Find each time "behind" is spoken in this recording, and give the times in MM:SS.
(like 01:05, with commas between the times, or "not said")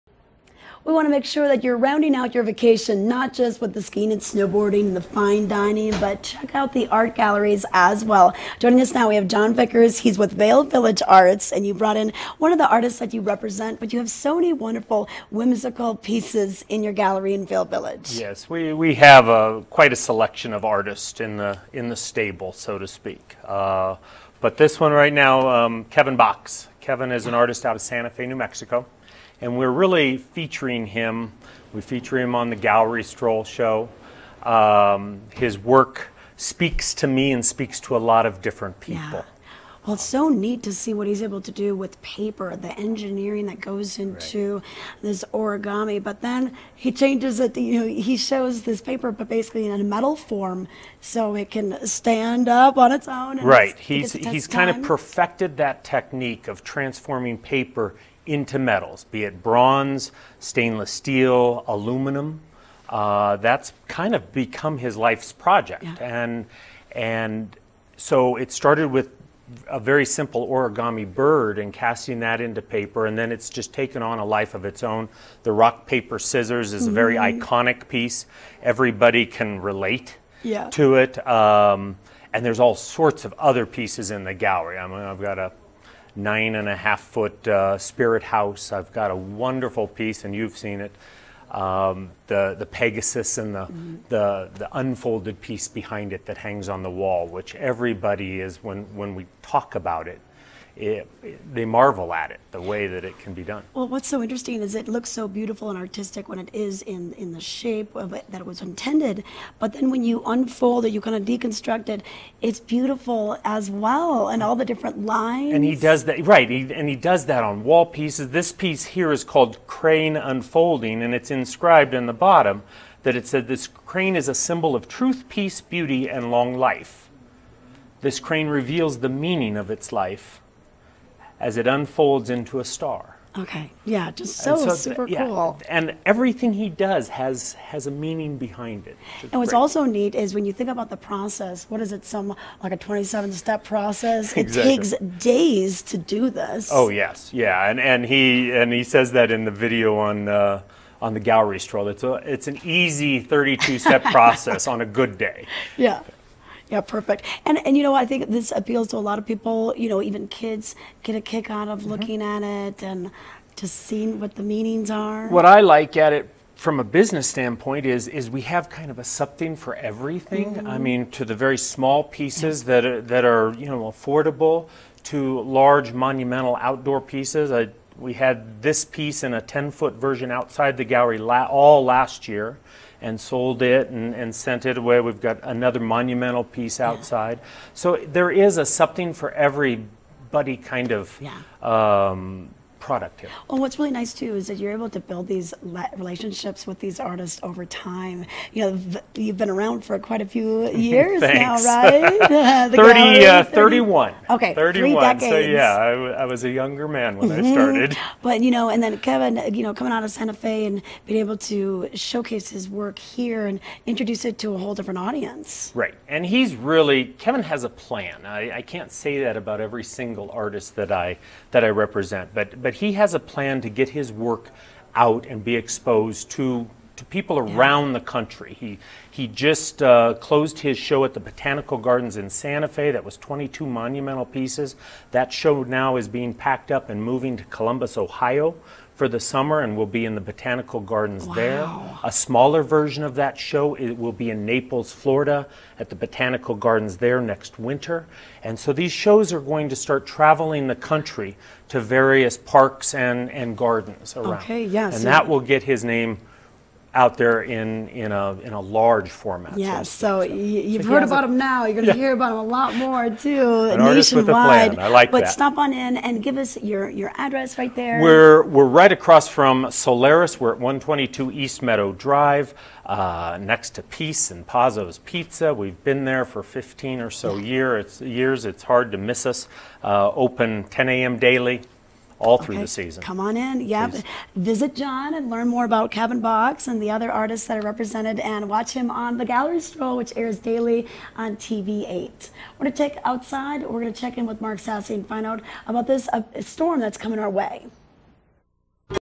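01:35, 02:18.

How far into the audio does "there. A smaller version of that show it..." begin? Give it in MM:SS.
04:01.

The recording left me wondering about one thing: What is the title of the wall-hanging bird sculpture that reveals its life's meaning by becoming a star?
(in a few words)
Crane Unfolding.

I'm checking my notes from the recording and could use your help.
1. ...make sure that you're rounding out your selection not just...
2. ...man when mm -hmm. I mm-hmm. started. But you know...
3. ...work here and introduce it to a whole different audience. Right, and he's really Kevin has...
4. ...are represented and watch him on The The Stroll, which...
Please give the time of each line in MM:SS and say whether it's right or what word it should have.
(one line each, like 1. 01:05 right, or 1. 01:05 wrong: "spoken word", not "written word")
1. 00:01 wrong: "vacation", not "selection"
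2. 03:26 right
3. 03:32 right
4. 04:47 wrong: "Gallery", not "The".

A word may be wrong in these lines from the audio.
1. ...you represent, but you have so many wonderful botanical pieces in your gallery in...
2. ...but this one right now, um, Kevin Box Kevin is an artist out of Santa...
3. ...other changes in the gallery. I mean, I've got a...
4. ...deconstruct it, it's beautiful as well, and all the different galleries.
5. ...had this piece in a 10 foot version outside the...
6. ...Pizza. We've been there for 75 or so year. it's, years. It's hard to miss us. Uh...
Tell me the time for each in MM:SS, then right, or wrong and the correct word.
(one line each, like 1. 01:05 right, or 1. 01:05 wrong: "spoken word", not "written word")
1. 00:13 wrong: "whimsical", not "botanical"
2. 00:24 right
3. 01:23 wrong: "pieces", not "changes"
4. 01:51 wrong: "lines", not "galleries"
5. 02:58 right
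6. 04:34 wrong: "15", not "75".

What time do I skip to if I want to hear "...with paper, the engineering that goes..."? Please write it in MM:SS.
00:41.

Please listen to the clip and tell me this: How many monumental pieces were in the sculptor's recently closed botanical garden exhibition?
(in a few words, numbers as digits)
22.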